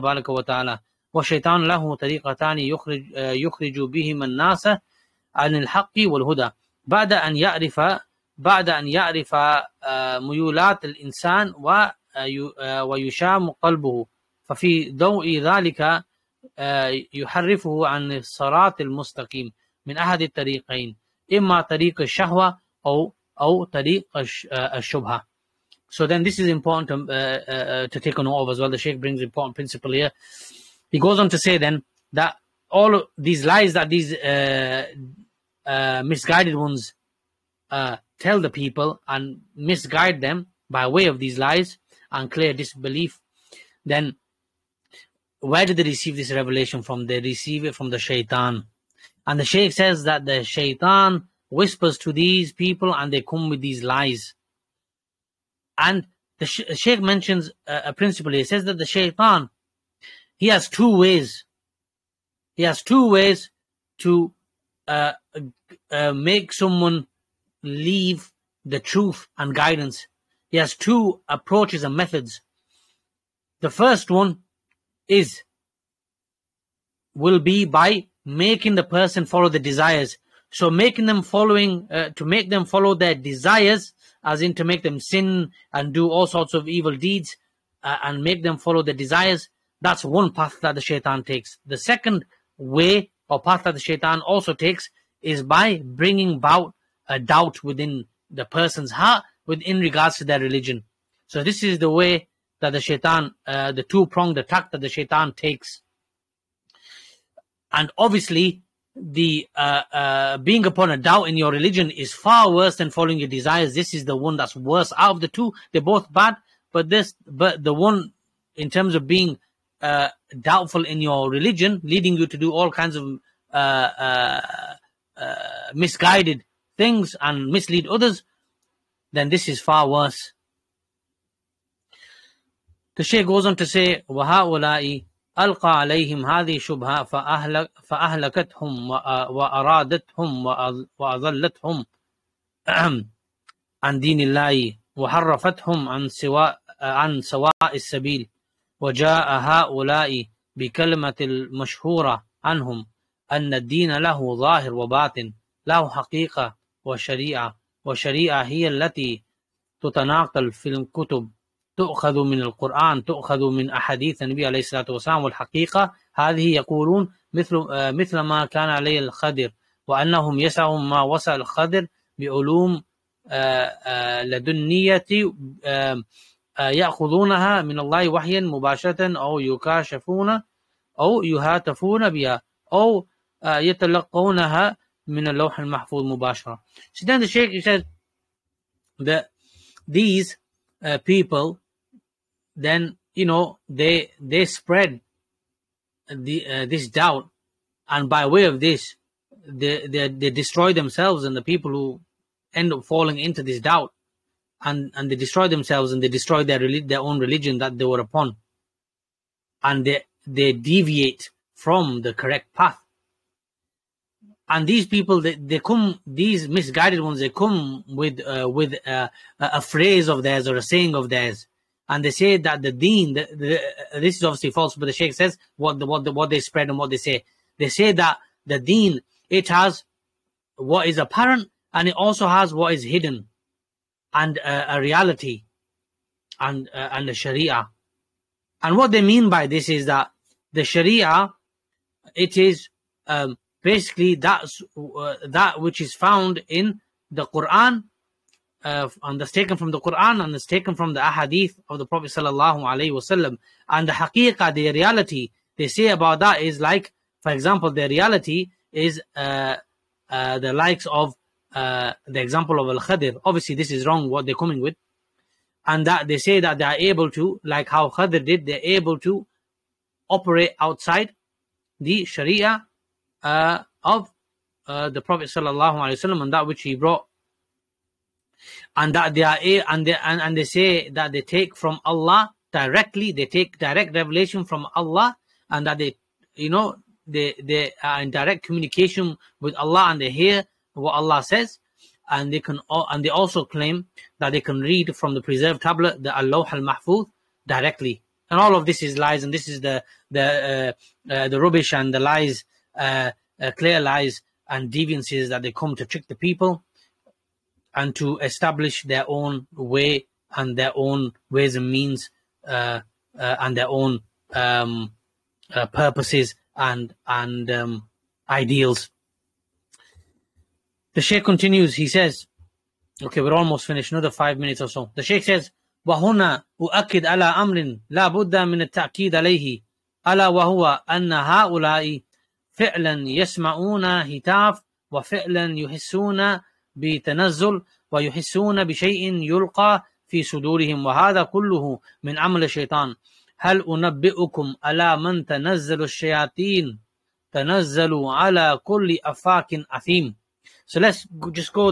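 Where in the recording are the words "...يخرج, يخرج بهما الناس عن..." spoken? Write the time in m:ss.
0:02.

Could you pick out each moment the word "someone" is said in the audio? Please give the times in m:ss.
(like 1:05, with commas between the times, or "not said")
1:06.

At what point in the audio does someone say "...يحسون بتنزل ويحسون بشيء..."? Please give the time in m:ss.
5:35.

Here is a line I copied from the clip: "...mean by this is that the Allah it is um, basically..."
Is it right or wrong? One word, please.
wrong.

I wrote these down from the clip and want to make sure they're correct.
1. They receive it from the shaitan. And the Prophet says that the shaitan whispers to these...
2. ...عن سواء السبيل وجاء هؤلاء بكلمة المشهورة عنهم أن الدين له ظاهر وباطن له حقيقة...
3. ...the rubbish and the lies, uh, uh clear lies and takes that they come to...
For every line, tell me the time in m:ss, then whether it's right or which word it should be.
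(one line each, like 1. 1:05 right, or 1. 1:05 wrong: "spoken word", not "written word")
1. 0:47 wrong: "Shaykh", not "Prophet"
2. 2:26 right
3. 5:01 wrong: "deviances", not "takes".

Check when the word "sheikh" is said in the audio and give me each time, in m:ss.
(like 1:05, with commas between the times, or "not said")
0:28, 3:07, 3:44, 5:21, 5:25.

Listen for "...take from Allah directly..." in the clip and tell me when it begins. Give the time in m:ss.
4:41.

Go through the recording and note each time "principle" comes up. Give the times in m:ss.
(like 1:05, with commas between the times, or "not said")
0:29, 0:57.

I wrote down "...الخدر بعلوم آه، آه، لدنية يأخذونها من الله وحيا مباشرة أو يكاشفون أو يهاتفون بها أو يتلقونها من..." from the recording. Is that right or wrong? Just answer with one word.
right.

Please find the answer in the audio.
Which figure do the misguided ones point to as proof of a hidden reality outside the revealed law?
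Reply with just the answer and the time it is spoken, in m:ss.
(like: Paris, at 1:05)
Al Khadir, at 4:22.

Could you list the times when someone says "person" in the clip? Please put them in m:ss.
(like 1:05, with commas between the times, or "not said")
1:18, 1:38.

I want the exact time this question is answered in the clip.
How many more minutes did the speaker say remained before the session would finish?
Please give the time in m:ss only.
5:24.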